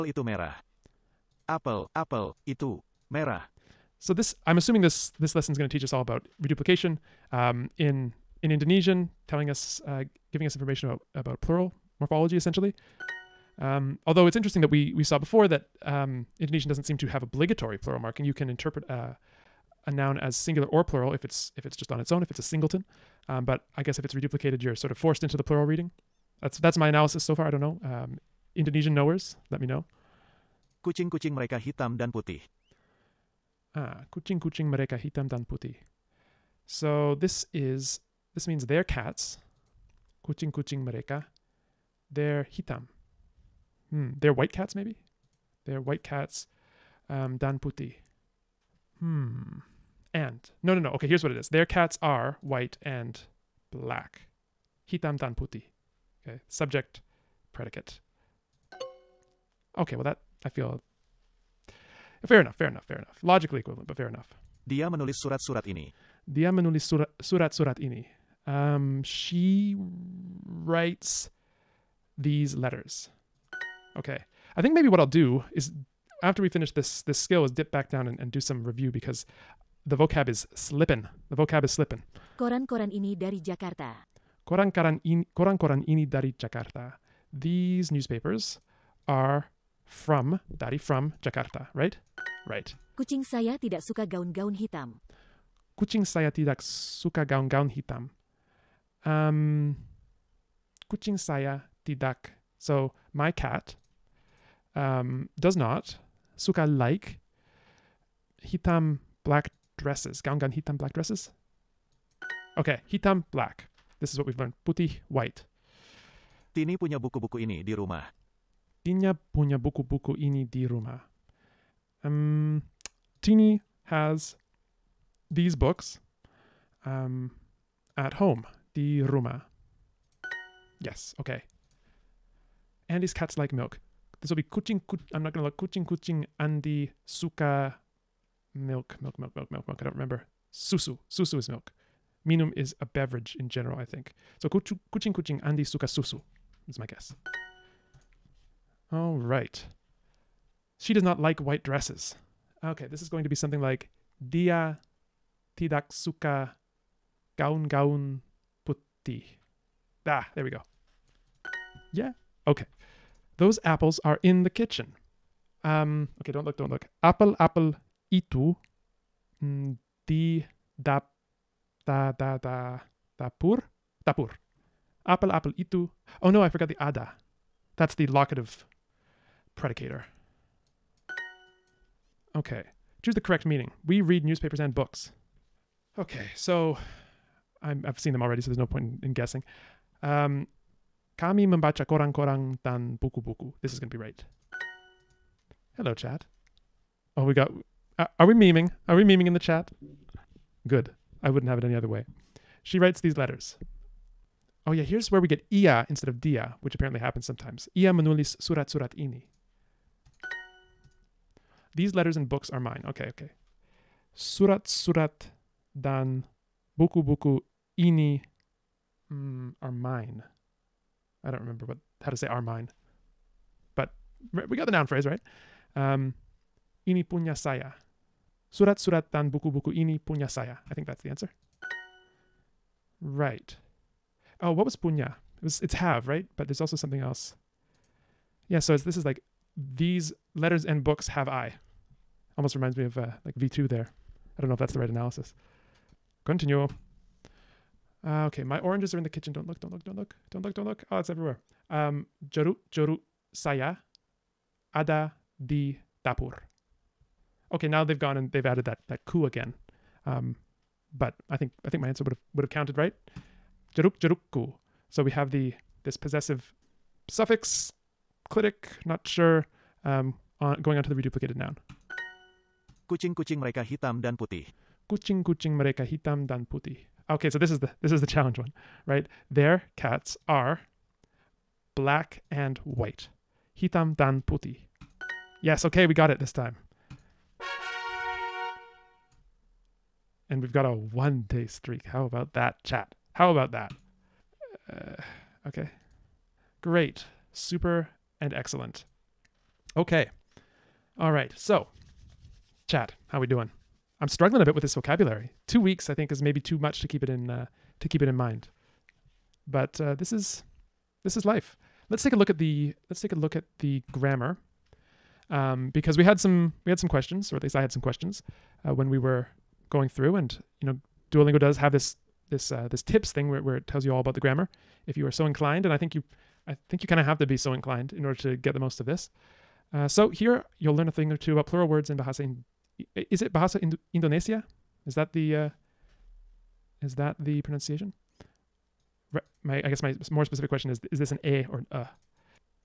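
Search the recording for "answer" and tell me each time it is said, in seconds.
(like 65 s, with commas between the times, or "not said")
231 s, 261 s.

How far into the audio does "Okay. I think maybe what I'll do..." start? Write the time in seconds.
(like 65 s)
73 s.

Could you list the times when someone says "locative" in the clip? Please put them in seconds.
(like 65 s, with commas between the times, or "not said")
178 s.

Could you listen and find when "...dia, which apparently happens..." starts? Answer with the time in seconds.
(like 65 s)
206 s.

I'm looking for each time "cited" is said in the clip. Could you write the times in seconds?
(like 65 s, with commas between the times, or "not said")
not said.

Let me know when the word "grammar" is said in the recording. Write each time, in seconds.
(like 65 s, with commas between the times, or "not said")
313 s, 324 s.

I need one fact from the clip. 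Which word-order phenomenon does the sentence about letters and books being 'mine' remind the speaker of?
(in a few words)
V2.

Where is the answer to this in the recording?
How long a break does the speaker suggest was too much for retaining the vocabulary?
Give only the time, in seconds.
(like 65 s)
305 s.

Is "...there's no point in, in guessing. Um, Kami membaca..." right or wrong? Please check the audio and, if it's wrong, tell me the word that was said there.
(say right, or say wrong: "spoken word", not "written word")
right.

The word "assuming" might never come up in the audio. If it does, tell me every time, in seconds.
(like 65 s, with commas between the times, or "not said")
4 s.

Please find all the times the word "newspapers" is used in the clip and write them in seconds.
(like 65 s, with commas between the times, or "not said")
87 s, 184 s.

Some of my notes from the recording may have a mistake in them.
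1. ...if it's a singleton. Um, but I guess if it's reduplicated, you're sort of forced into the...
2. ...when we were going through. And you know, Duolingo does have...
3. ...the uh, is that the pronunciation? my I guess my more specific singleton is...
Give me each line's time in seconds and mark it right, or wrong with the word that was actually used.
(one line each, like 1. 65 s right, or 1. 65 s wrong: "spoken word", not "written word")
1. 22 s right
2. 318 s right
3. 335 s wrong: "question", not "singleton".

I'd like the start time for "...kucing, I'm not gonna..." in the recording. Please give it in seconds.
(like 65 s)
134 s.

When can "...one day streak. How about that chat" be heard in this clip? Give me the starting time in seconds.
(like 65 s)
290 s.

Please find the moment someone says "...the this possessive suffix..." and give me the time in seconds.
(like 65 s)
265 s.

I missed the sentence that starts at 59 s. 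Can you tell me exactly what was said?
Okay, well that I feel fair enough, fair enough, fair enough.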